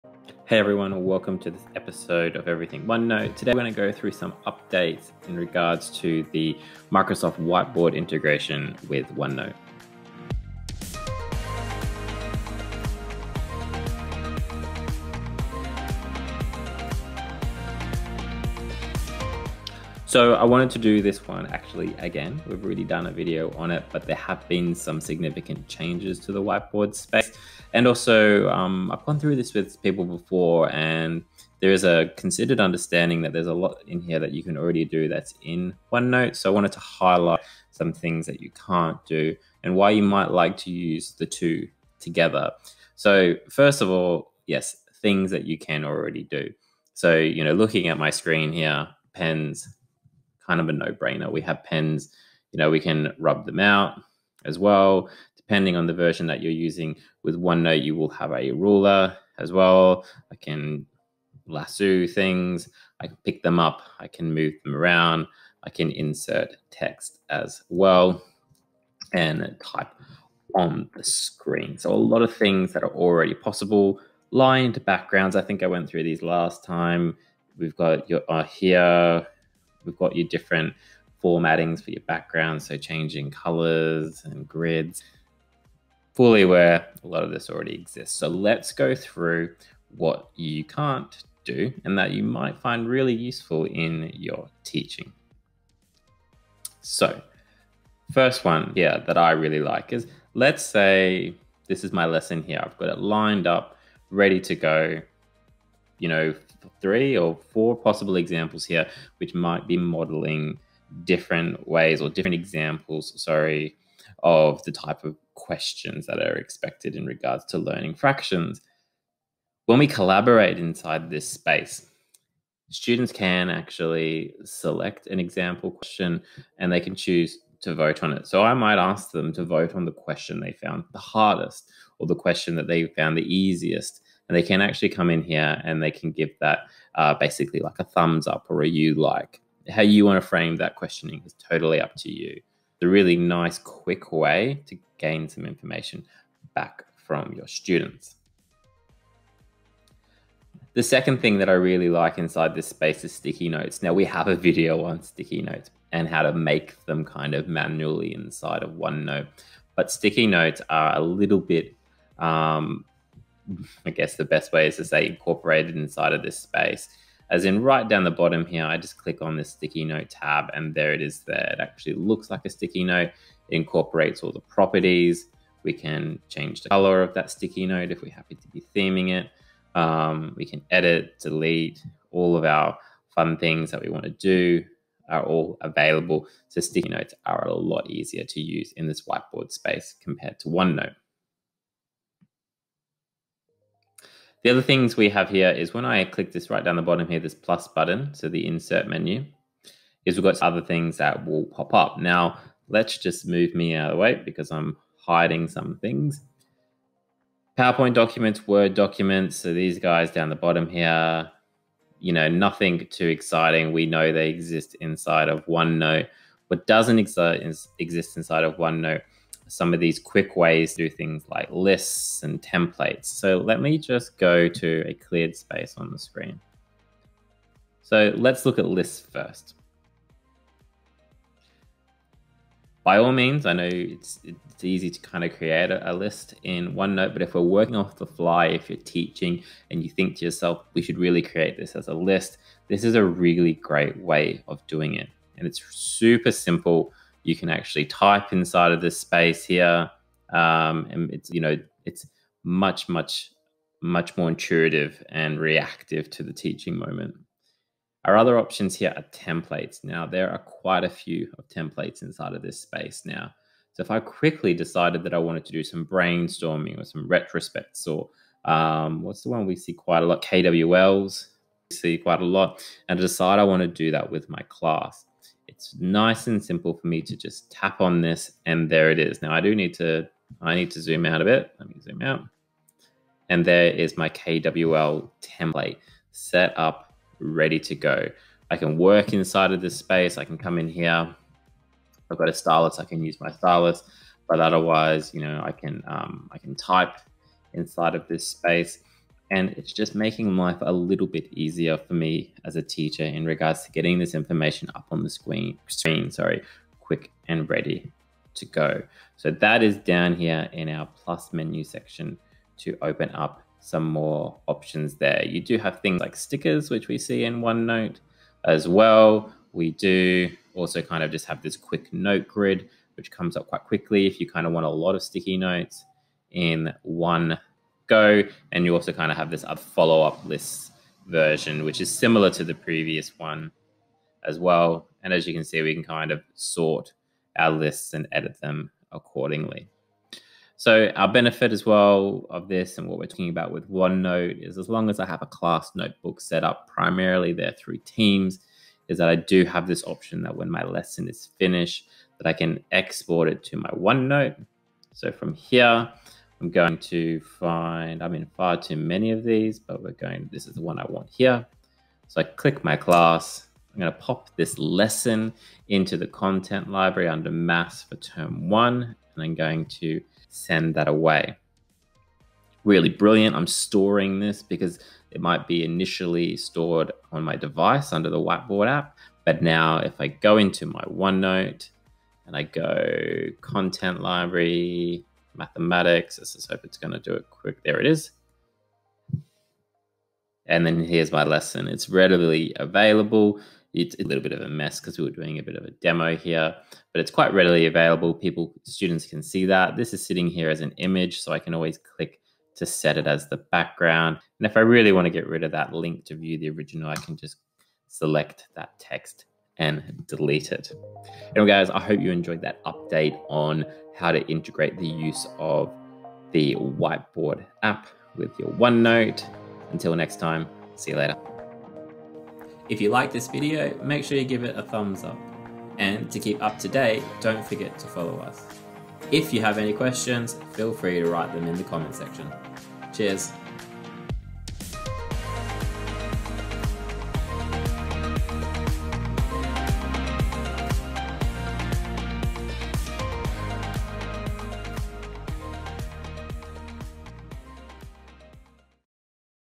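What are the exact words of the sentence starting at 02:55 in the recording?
We can change the color of that sticky note if we happen to be theming it.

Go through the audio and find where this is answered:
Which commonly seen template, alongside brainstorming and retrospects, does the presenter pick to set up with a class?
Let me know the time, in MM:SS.
04:30.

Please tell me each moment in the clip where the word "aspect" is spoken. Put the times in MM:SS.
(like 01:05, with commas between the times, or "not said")
not said.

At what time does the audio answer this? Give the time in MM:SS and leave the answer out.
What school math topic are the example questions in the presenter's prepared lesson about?
01:57.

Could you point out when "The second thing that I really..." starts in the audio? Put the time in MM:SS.
02:30.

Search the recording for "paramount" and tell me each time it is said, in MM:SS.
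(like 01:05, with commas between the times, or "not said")
not said.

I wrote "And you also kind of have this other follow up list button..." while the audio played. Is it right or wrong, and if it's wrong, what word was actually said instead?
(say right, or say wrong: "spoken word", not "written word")
wrong: "version", not "button".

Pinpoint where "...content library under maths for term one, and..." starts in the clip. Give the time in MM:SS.
06:06.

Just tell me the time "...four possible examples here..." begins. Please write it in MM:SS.
01:47.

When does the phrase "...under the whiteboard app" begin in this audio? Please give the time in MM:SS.
06:17.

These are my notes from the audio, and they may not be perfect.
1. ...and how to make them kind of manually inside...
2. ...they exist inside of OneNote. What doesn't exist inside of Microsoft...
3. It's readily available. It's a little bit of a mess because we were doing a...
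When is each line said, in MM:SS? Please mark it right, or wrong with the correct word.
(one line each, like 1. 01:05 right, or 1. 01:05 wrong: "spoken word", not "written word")
1. 02:35 right
2. 03:34 wrong: "OneNote", not "Microsoft"
3. 06:31 right.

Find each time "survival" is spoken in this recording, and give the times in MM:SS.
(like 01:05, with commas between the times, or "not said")
not said.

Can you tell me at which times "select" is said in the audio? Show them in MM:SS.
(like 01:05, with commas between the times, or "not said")
02:04, 06:47.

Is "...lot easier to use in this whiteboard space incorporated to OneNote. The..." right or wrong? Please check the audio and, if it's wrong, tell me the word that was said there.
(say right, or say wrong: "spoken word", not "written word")
wrong: "compared", not "incorporated".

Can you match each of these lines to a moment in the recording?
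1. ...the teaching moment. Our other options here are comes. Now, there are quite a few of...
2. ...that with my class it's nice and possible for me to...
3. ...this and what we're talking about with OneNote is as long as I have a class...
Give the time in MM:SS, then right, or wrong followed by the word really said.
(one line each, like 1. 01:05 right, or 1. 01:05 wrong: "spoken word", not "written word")
1. 04:16 wrong: "templates", not "comes"
2. 04:33 wrong: "simple", not "possible"
3. 05:42 right.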